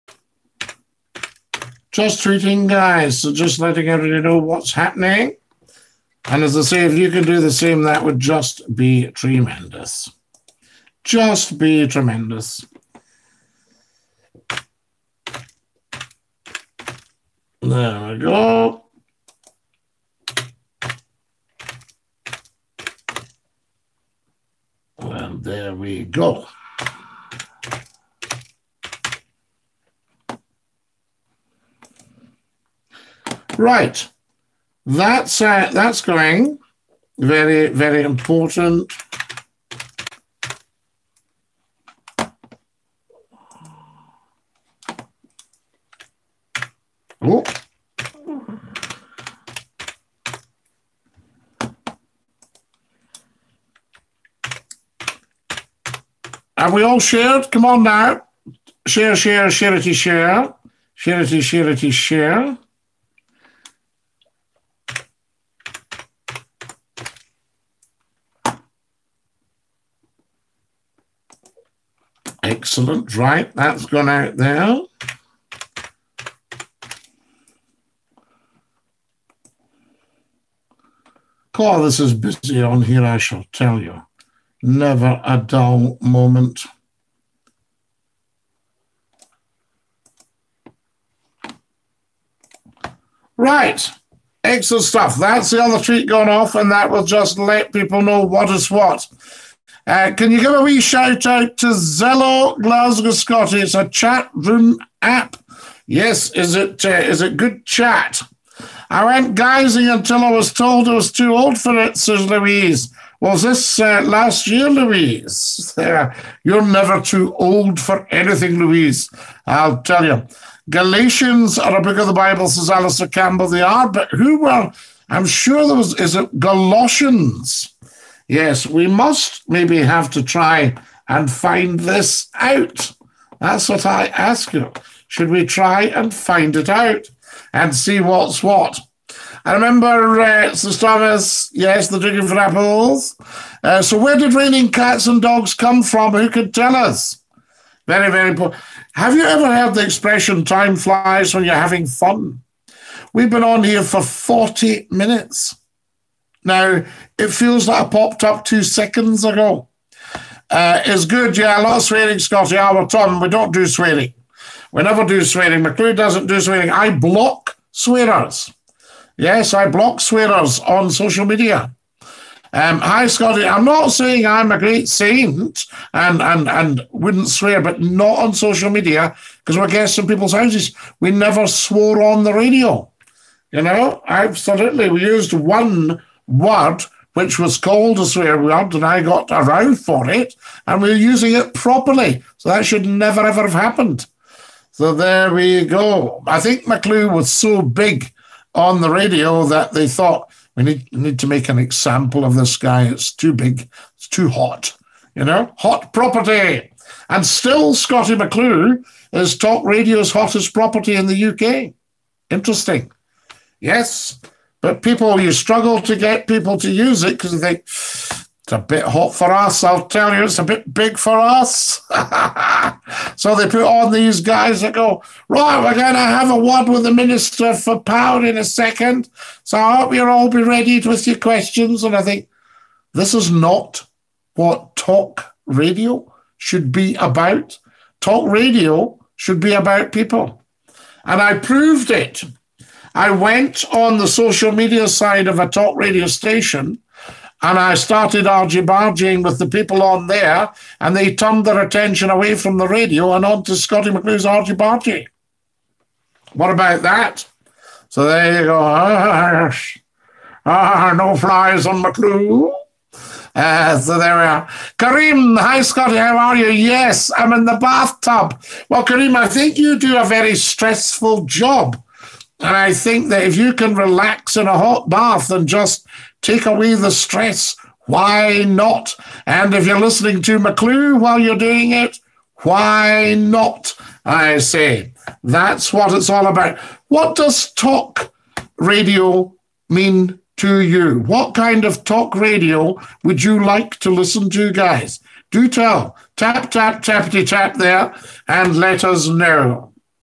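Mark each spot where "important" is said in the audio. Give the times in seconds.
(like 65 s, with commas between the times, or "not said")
38 s, 148 s.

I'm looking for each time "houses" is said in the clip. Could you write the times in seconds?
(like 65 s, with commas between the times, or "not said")
180 s.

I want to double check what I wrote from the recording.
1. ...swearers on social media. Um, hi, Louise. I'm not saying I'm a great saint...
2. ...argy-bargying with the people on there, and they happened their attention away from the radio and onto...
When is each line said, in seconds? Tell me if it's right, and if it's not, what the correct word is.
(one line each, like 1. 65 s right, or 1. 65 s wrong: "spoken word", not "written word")
1. 170 s wrong: "Scottie", not "Louise"
2. 248 s wrong: "turned", not "happened".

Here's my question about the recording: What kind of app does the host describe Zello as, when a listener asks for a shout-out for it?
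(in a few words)
Chat room app.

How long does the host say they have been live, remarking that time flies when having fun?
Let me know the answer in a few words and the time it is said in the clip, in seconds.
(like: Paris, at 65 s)
40 minutes, at 154 s.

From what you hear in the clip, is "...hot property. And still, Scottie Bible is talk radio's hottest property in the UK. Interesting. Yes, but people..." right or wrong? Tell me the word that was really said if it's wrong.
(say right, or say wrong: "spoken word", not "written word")
wrong: "McClue", not "Bible".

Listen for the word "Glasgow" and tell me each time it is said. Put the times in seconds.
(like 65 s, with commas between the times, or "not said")
102 s.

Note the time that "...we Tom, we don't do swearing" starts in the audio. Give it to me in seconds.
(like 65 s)
162 s.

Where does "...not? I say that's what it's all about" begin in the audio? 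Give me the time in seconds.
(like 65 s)
283 s.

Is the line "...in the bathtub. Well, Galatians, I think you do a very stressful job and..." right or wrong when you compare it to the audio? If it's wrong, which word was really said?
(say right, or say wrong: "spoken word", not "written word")
wrong: "Kareem", not "Galatians".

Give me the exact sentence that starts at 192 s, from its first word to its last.
So that should never ever have happened.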